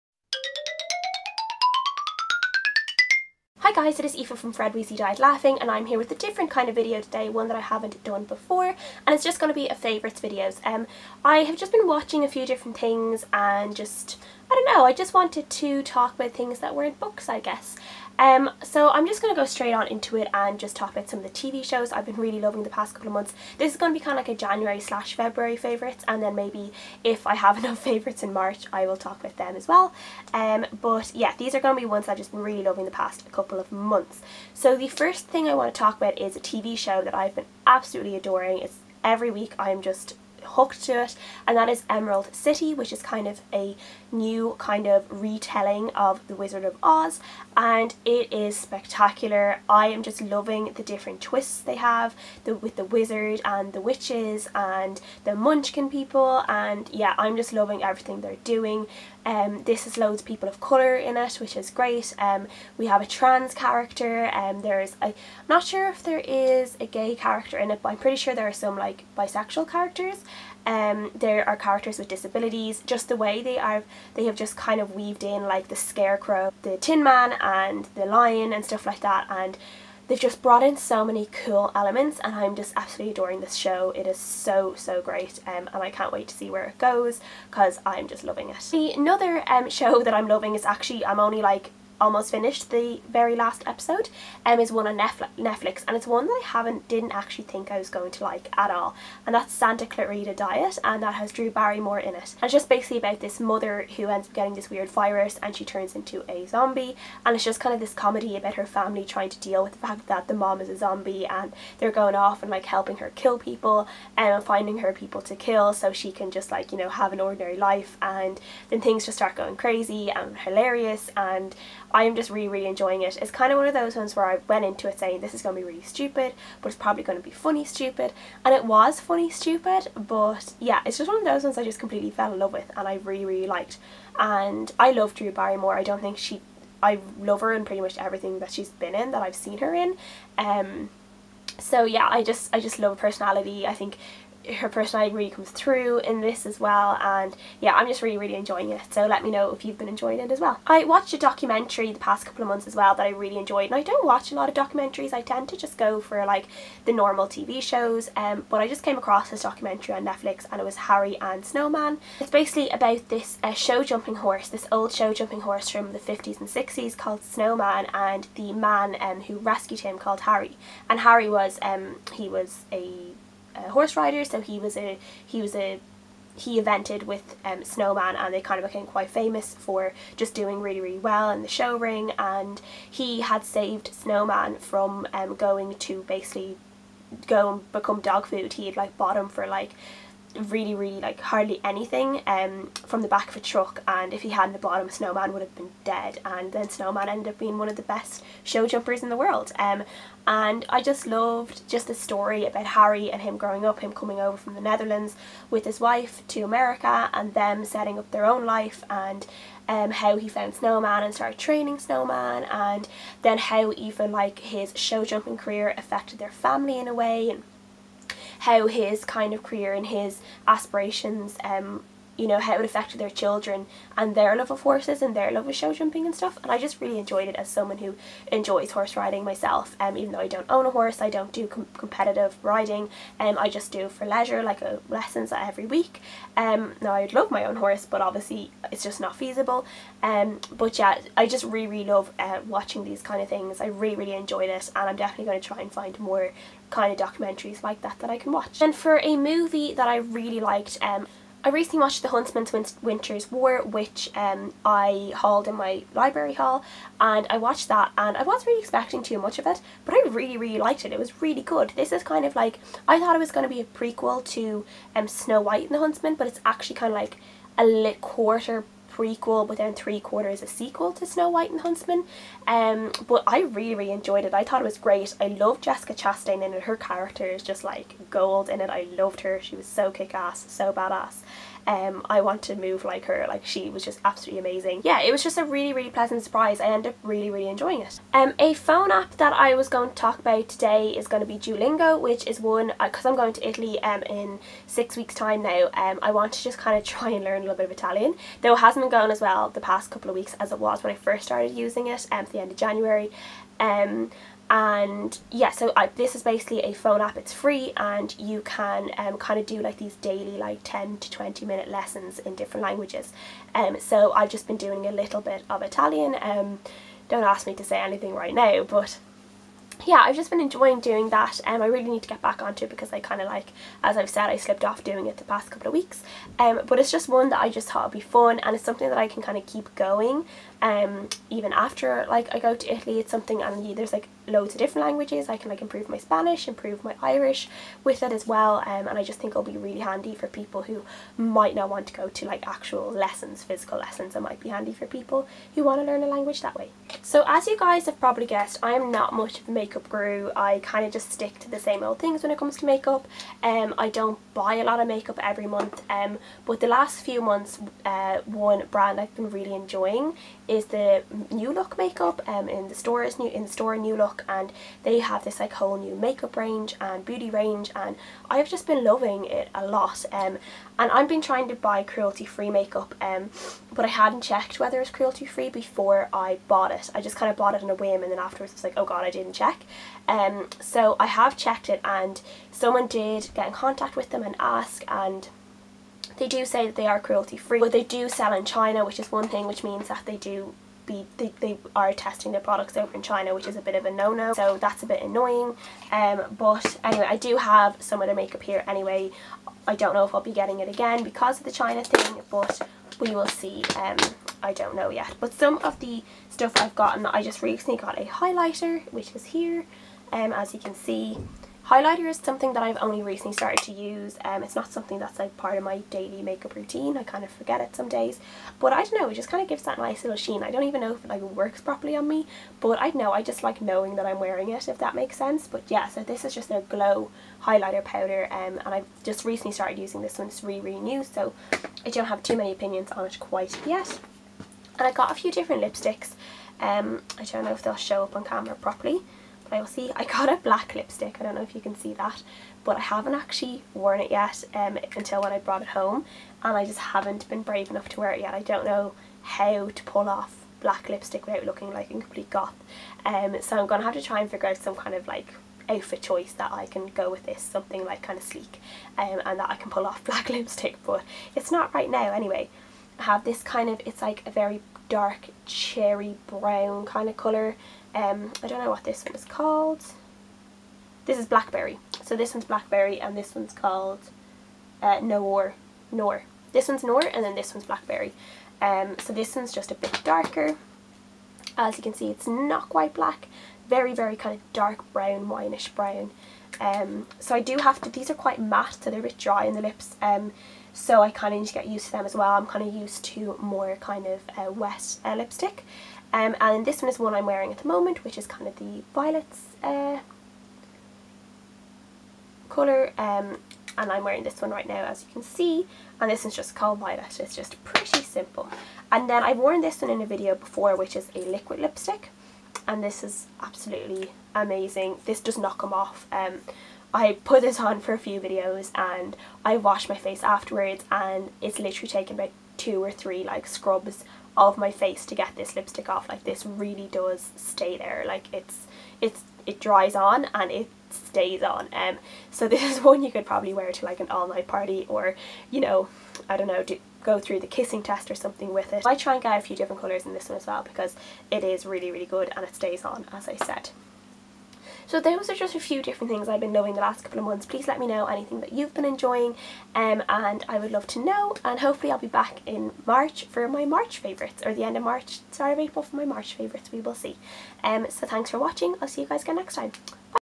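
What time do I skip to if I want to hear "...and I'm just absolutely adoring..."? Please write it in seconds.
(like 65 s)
82 s.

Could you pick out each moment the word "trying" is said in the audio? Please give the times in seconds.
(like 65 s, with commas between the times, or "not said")
109 s, 371 s.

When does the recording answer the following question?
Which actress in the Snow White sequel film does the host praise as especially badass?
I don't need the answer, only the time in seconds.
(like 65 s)
275 s.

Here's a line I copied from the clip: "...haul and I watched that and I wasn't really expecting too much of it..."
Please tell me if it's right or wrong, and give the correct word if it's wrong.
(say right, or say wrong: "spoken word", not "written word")
right.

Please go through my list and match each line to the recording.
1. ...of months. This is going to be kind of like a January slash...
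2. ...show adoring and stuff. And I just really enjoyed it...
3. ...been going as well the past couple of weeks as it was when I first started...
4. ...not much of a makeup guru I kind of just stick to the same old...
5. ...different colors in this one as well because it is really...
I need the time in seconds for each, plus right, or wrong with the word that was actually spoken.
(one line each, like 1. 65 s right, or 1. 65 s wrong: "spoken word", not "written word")
1. 23 s right
2. 225 s wrong: "jumping", not "adoring"
3. 298 s right
4. 348 s right
5. 539 s right.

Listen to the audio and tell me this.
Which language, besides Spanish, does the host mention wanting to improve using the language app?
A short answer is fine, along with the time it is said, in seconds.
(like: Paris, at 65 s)
Irish, at 337 s.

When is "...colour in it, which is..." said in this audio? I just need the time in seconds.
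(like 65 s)
60 s.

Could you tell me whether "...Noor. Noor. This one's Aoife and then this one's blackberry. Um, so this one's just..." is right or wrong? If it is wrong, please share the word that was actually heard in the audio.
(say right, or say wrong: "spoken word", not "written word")
wrong: "Noor", not "Aoife".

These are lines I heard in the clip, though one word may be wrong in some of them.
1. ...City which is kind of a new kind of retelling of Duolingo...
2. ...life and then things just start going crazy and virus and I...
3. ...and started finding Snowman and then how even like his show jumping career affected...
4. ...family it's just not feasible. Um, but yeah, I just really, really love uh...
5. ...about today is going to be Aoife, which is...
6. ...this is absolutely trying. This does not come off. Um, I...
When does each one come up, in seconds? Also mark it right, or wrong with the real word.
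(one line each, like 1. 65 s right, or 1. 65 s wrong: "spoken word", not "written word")
1. 42 s wrong: "The", not "Duolingo"
2. 117 s wrong: "hilarious", not "virus"
3. 211 s wrong: "training", not "finding"
4. 238 s wrong: "obviously", not "family"
5. 290 s wrong: "Duolingo", not "Aoife"
6. 512 s wrong: "amazing", not "trying".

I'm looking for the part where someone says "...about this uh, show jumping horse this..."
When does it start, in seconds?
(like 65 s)
162 s.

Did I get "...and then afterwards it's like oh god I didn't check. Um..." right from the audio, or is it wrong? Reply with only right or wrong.
right.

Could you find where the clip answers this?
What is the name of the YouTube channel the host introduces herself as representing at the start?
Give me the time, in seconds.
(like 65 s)
4 s.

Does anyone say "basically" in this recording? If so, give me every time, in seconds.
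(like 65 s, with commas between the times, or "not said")
102 s, 162 s, 186 s, 306 s.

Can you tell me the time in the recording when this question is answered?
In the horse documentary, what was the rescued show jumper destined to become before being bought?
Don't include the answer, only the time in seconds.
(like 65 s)
187 s.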